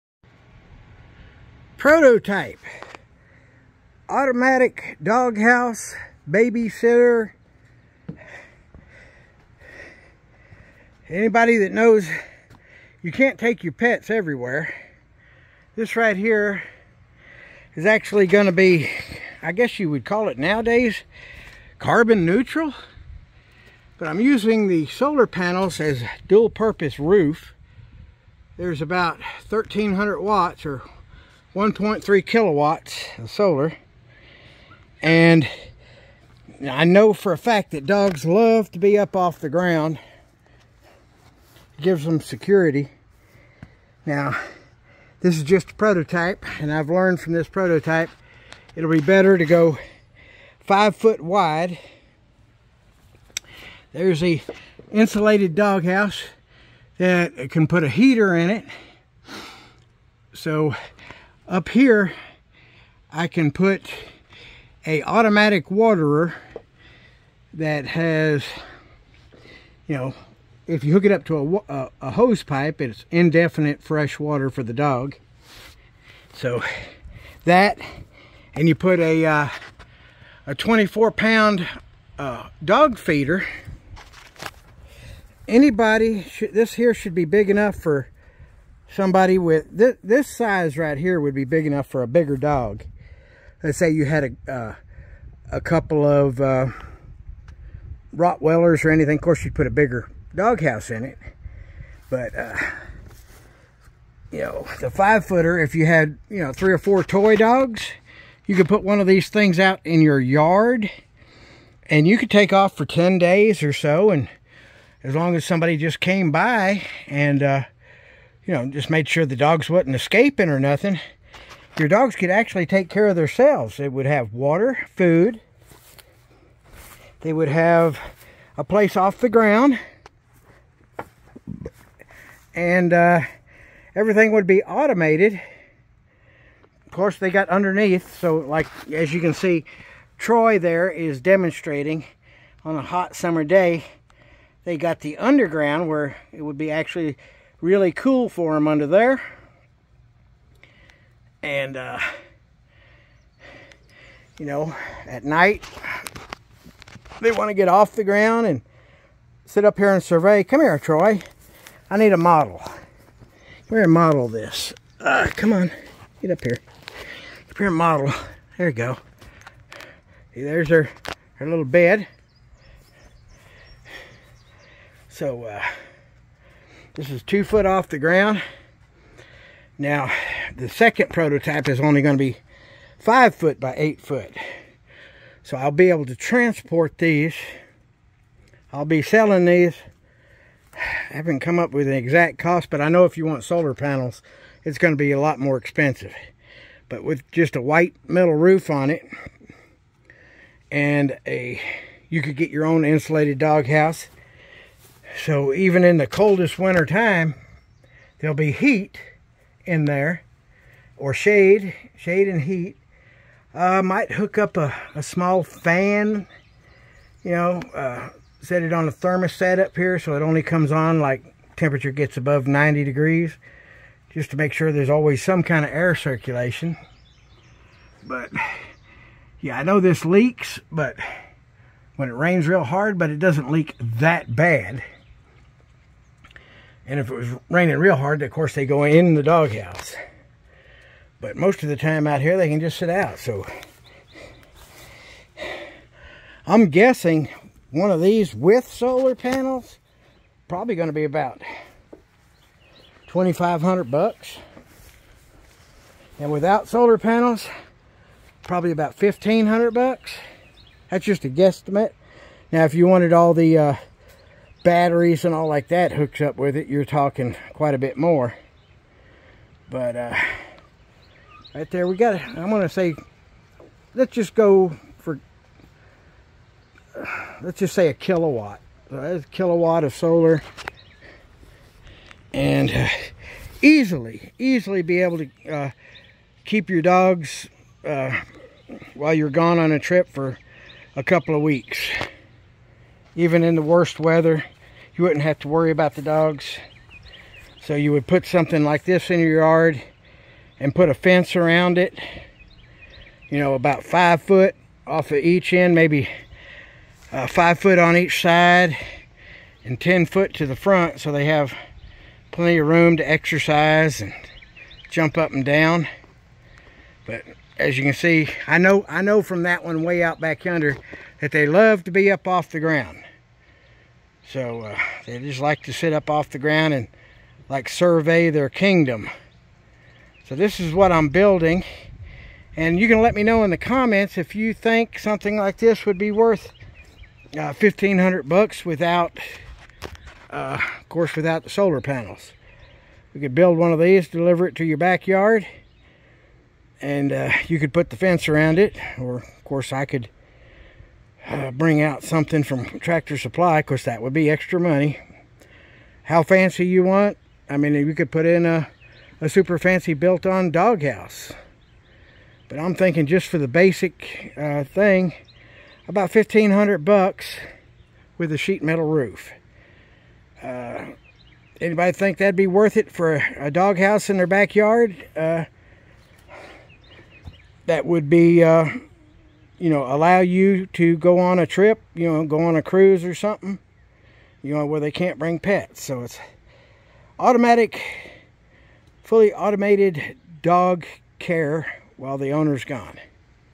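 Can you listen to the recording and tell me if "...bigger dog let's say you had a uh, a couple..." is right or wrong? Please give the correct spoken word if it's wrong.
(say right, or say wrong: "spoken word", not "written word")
right.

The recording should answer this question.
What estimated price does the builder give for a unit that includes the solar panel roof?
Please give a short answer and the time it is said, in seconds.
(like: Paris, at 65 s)
$2500, at 253 s.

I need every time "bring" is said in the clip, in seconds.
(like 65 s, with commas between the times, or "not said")
351 s, 385 s.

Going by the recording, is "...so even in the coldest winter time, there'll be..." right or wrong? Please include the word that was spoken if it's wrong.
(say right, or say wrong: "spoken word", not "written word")
right.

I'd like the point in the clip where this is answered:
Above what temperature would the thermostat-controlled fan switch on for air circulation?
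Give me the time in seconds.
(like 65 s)
222 s.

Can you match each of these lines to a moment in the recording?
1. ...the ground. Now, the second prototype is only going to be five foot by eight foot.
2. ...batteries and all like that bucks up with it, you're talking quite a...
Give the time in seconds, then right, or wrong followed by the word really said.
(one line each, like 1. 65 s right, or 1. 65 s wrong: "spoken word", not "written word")
1. 177 s right
2. 264 s wrong: "hooks", not "bucks".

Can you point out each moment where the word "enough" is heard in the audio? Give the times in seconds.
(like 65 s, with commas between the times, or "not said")
87 s, 91 s.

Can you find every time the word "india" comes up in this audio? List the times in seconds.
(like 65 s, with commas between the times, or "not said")
not said.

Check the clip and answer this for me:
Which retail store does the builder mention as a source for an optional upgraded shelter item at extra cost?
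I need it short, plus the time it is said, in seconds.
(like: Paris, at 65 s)
Tractor Supply, at 352 s.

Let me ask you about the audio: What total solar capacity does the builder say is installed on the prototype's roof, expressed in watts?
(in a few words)
1300 watts.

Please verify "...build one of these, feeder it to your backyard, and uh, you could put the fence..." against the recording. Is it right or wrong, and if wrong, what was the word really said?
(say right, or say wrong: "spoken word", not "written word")
wrong: "deliver", not "feeder".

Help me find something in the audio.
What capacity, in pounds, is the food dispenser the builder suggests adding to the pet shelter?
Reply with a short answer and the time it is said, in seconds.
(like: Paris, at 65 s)
24 pounds, at 80 s.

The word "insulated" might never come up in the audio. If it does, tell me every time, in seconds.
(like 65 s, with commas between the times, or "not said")
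54 s, 202 s.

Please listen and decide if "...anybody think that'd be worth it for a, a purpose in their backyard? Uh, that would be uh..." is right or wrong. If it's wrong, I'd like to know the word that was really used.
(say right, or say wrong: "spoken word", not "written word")
wrong: "doghouse", not "purpose".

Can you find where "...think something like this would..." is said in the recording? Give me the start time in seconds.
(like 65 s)
334 s.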